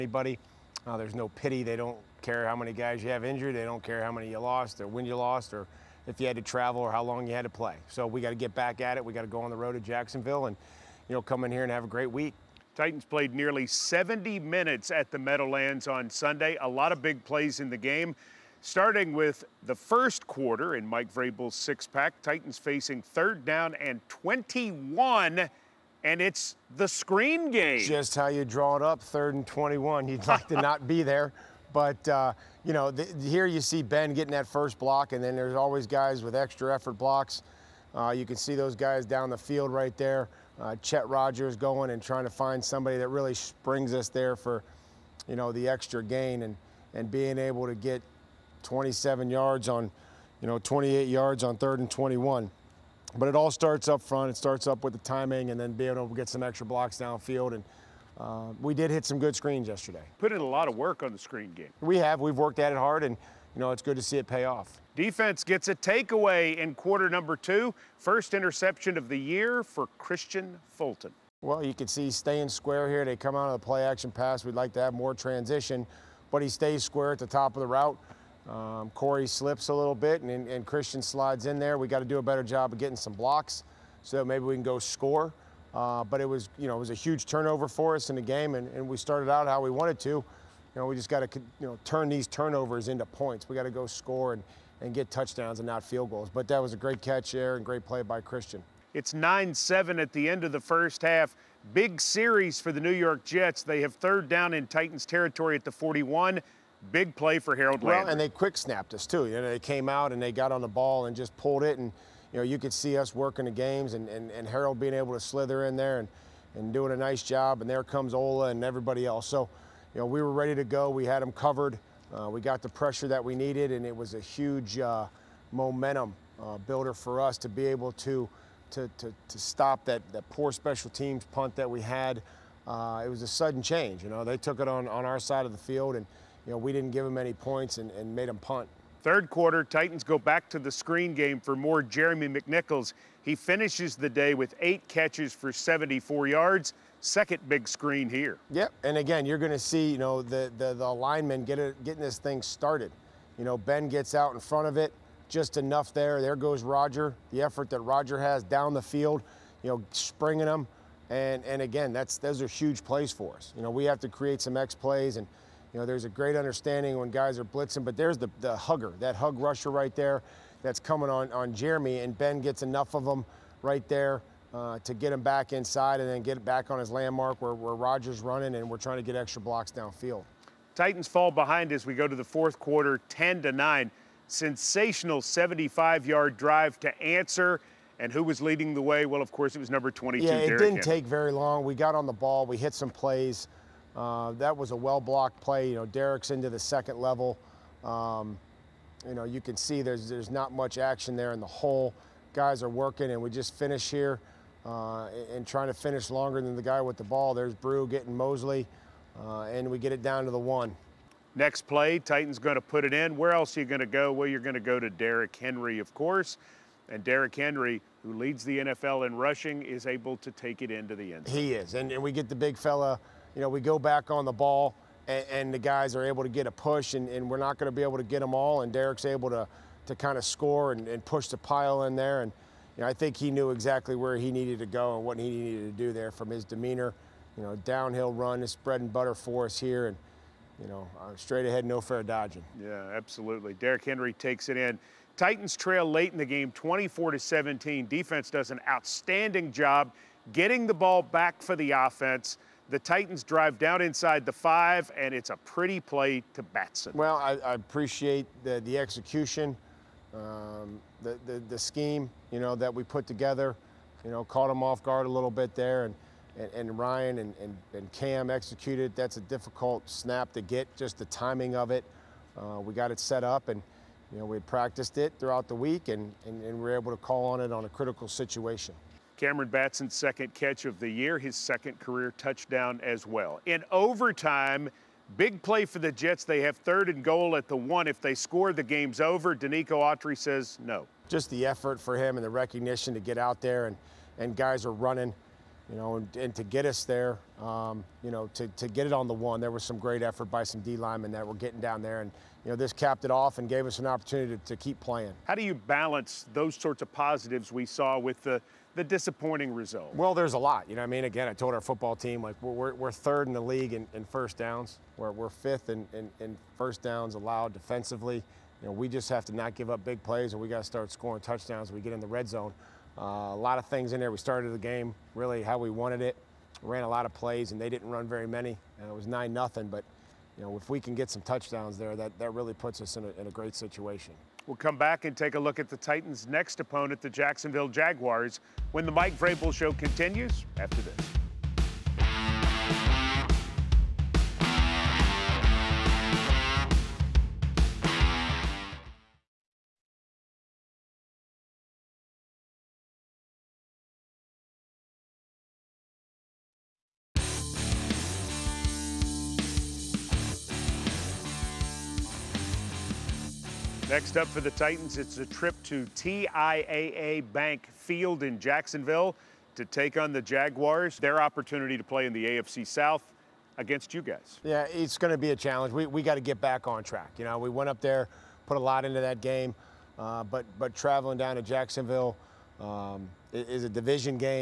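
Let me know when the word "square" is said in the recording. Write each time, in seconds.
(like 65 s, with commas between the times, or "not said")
72 s, 76 s.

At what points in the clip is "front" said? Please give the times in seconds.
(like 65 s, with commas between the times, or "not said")
54 s, 154 s.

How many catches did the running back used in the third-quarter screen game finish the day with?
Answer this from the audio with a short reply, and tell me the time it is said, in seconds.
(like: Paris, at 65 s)
8, at 144 s.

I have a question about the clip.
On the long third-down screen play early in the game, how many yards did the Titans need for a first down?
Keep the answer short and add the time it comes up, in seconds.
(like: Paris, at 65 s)
21, at 23 s.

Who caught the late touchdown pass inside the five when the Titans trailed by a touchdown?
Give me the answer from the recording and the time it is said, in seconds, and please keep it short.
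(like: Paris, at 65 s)
Cameron Batson, at 279 s.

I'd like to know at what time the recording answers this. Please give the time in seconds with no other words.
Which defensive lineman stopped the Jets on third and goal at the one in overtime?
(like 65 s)
289 s.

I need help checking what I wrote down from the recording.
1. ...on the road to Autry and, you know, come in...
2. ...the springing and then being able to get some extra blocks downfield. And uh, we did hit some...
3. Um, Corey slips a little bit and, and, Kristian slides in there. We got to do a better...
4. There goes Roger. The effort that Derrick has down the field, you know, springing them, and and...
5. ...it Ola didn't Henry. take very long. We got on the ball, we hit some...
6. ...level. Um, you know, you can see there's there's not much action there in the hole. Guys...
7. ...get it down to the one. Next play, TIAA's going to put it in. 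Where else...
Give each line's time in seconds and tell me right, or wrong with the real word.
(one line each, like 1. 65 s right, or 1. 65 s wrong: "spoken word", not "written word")
1. 9 s wrong: "Jacksonville", not "Autry"
2. 54 s wrong: "timing", not "springing"
3. 78 s right
4. 156 s wrong: "Roger", not "Derrick"
5. 190 s wrong: "Derrick", not "Ola"
6. 196 s right
7. 209 s wrong: "Titan", not "TIAA".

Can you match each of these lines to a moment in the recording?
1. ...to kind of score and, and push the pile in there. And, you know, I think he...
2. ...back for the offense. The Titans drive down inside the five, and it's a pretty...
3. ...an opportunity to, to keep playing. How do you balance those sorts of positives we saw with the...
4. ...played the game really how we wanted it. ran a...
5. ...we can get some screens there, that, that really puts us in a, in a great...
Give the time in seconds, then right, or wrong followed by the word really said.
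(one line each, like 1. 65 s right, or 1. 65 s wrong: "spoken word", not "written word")
1. 229 s right
2. 251 s right
3. 303 s right
4. 324 s wrong: "started", not "played"
5. 330 s wrong: "touchdowns", not "screens".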